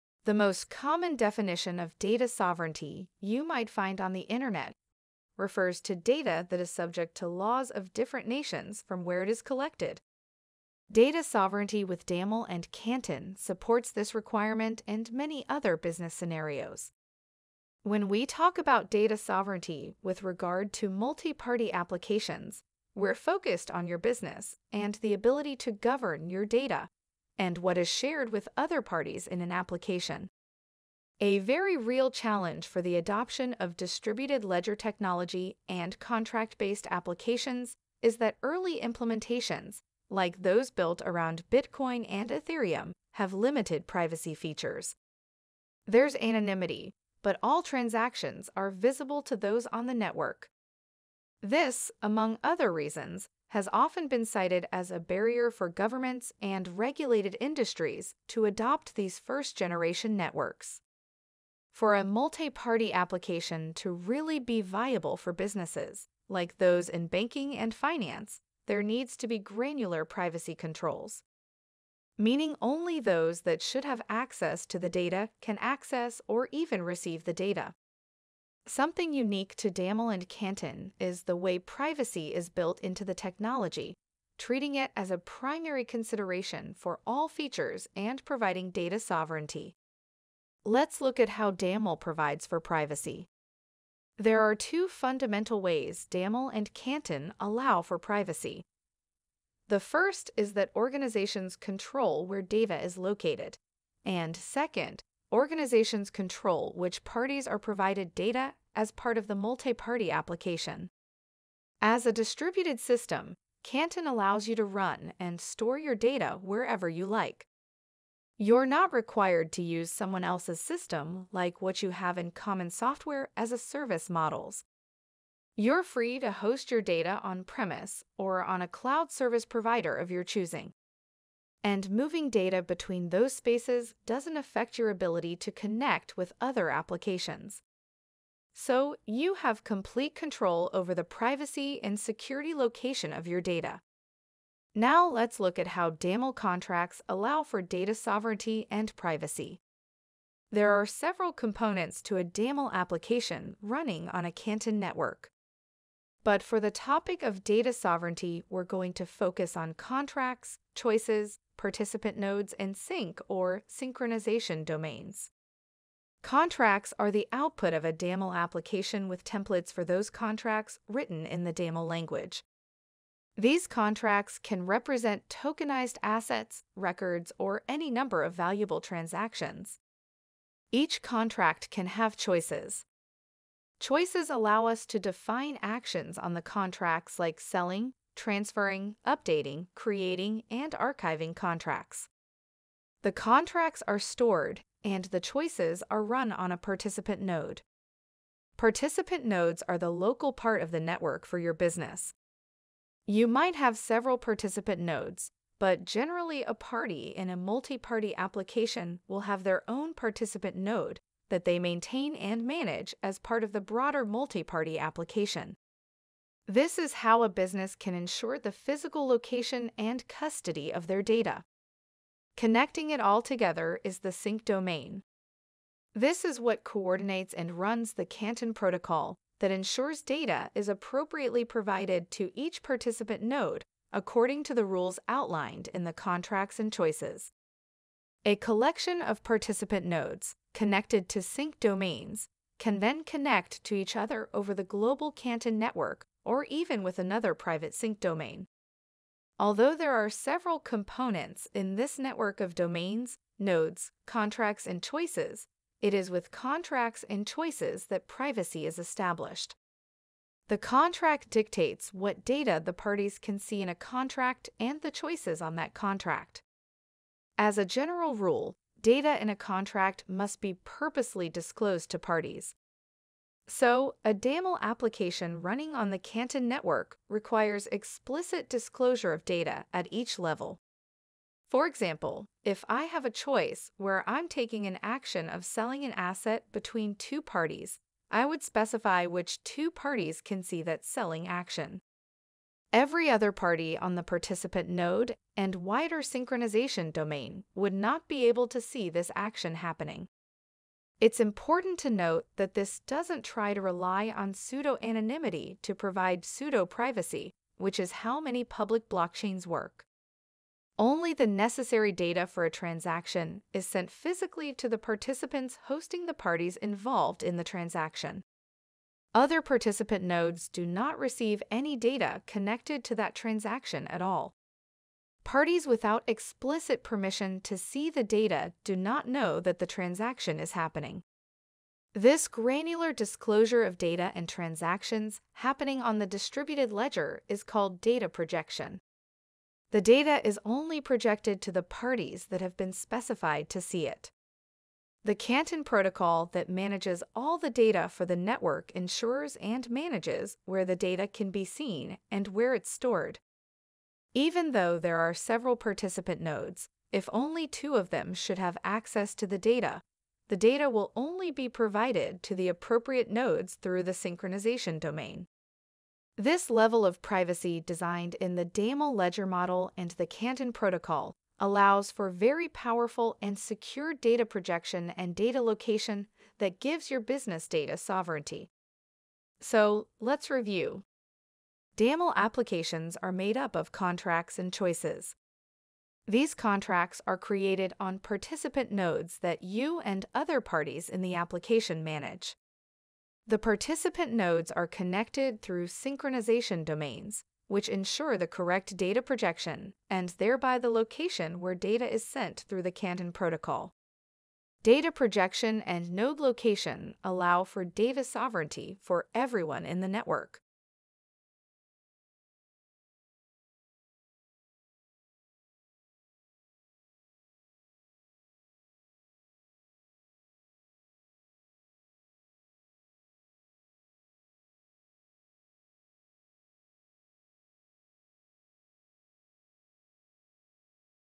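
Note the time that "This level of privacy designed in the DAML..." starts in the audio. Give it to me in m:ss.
6:06.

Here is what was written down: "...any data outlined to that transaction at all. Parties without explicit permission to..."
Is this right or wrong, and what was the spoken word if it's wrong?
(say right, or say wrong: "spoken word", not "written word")
wrong: "connected", not "outlined".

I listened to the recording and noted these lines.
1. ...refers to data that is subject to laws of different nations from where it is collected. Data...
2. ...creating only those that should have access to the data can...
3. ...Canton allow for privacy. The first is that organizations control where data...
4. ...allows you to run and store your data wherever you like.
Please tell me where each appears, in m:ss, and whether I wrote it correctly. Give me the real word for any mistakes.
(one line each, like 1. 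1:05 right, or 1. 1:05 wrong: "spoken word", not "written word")
1. 0:05 right
2. 1:12 wrong: "meaning", not "creating"
3. 1:36 right
4. 1:54 right.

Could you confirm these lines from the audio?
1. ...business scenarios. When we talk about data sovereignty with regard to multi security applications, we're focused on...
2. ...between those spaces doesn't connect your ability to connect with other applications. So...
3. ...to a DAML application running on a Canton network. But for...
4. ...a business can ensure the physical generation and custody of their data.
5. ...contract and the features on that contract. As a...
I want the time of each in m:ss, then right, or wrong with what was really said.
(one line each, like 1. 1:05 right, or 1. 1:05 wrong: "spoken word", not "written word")
1. 0:15 wrong: "party", not "security"
2. 2:12 wrong: "affect", not "connect"
3. 2:32 right
4. 3:37 wrong: "location", not "generation"
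5. 4:23 wrong: "choices", not "features".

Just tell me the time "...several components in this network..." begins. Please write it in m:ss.
4:10.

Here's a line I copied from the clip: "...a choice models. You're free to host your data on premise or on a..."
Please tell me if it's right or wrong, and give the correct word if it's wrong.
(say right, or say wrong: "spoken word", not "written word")
wrong: "service", not "choice".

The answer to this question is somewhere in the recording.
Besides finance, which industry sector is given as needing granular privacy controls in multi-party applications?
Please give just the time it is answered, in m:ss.
1:07.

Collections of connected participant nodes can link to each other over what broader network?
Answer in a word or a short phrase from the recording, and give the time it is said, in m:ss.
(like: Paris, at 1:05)
global Canton network, at 4:04.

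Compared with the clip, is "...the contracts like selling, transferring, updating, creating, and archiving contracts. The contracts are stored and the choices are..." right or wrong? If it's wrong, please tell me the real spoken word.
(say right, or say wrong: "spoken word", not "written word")
right.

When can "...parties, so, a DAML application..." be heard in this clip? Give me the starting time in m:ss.
4:31.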